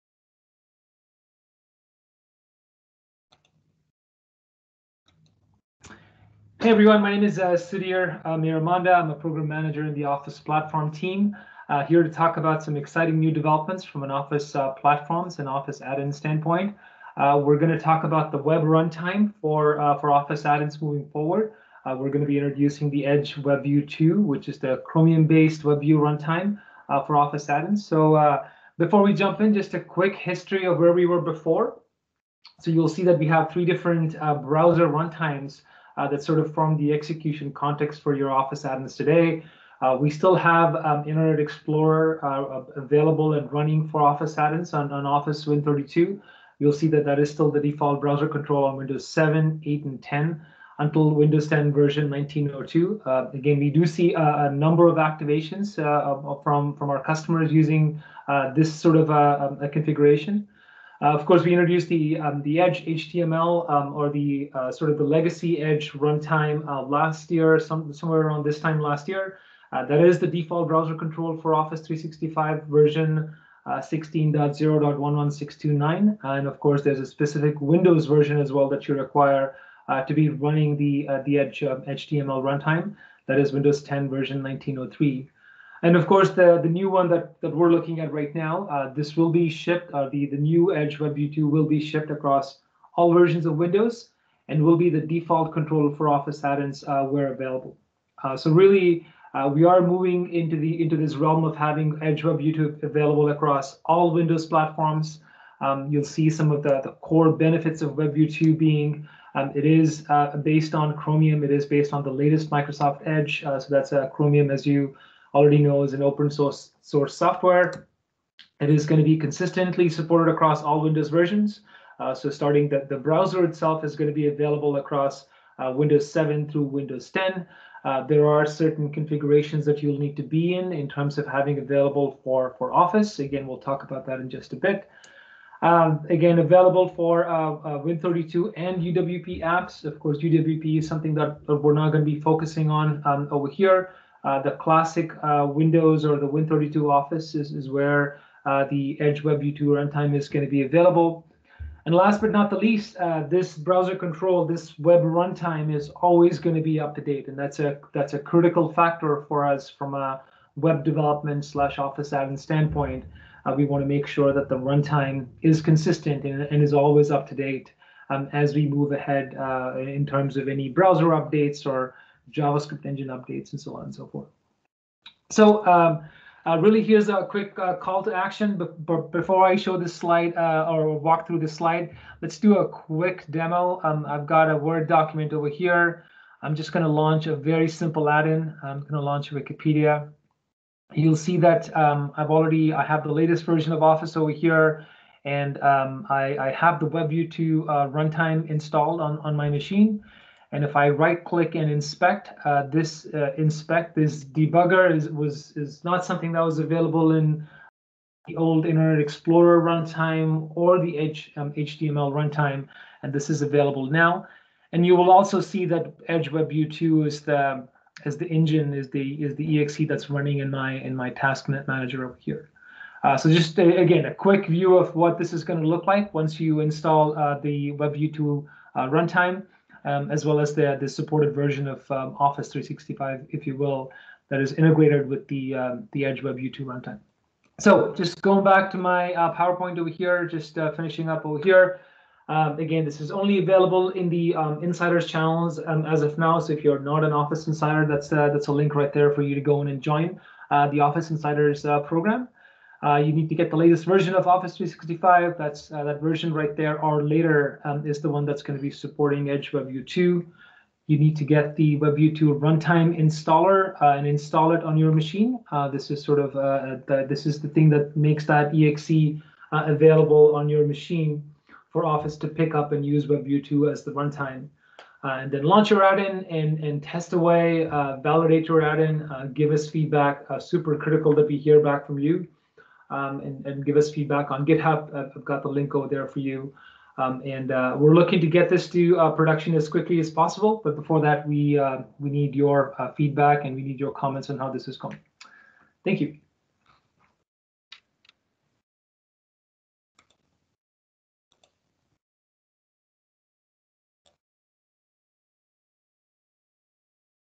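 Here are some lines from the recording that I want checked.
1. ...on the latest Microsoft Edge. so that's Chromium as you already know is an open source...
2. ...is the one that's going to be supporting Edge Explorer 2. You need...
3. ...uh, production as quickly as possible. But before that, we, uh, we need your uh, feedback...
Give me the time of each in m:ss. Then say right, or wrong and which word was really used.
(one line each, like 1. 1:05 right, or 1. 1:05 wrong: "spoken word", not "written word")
1. 1:51 right
2. 4:17 wrong: "WebView", not "Explorer"
3. 4:48 right.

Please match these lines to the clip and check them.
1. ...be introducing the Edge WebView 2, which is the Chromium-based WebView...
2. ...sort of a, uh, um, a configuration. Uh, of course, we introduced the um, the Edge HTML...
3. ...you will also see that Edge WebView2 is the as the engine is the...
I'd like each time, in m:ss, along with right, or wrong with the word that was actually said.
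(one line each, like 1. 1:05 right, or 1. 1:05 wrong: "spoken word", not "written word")
1. 0:22 right
2. 0:58 right
3. 3:34 right.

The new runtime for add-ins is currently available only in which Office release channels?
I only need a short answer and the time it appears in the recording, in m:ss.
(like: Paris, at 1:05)
Insiders channels, at 4:04.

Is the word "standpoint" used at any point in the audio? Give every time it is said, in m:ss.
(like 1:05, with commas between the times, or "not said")
0:16, 2:42.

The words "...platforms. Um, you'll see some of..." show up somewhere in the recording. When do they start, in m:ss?
1:44.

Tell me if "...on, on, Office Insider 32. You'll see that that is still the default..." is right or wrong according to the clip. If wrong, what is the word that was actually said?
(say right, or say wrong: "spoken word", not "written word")
wrong: "Win", not "Insider".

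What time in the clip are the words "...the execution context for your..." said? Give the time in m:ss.
0:36.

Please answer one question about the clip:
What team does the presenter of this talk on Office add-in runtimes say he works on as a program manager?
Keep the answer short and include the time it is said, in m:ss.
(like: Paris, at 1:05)
Office Platform team, at 0:10.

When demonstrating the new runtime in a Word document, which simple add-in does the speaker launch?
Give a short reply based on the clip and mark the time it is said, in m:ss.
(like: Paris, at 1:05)
Wikipedia, at 3:09.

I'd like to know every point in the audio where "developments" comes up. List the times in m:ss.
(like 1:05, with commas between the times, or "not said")
0:13, 2:40.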